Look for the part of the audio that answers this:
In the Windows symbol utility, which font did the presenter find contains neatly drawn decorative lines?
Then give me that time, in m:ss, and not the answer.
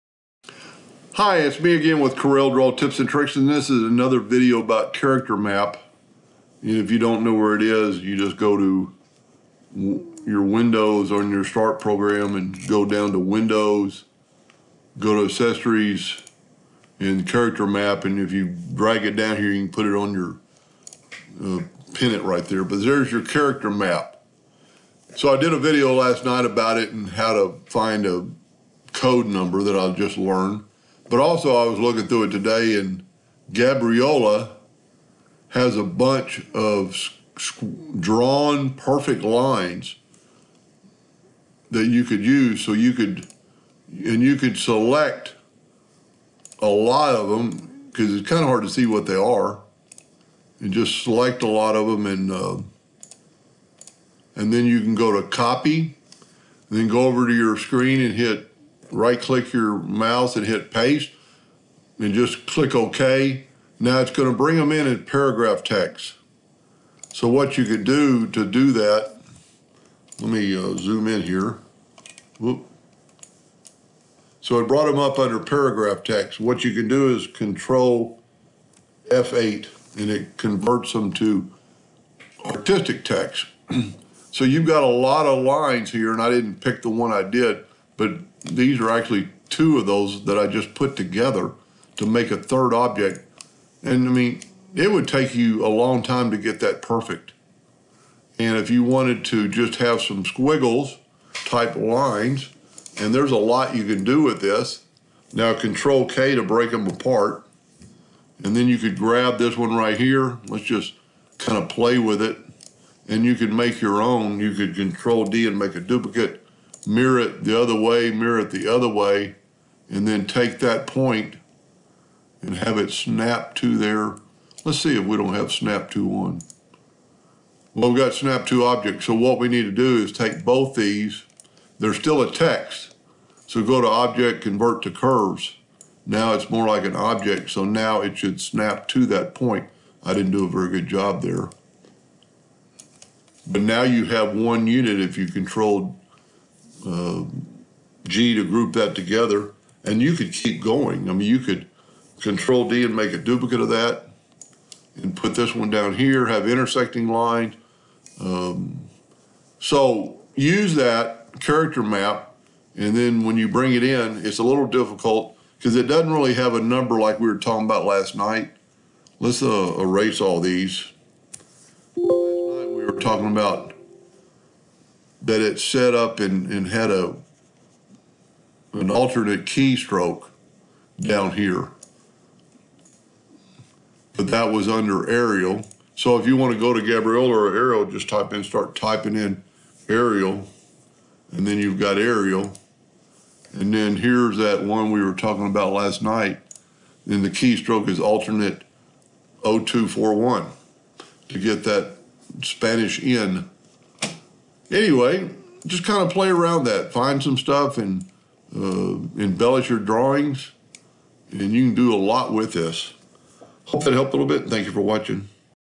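0:33.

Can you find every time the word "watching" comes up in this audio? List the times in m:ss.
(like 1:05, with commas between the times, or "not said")
3:34.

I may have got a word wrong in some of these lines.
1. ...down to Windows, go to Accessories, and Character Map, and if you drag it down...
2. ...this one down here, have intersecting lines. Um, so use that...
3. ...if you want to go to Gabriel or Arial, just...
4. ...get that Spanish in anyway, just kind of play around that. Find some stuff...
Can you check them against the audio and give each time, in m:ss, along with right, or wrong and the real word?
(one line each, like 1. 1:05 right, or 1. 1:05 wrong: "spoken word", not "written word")
1. 0:12 right
2. 2:35 right
3. 3:06 right
4. 3:21 right.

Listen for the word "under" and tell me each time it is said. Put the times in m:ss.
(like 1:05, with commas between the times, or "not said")
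1:15, 3:04.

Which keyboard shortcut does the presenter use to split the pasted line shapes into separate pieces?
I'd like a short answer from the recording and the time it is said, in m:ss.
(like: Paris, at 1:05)
Control K, at 1:45.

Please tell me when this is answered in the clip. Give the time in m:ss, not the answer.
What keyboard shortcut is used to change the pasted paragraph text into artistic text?
1:17.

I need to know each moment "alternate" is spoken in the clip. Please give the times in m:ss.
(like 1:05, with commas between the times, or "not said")
2:58, 3:17.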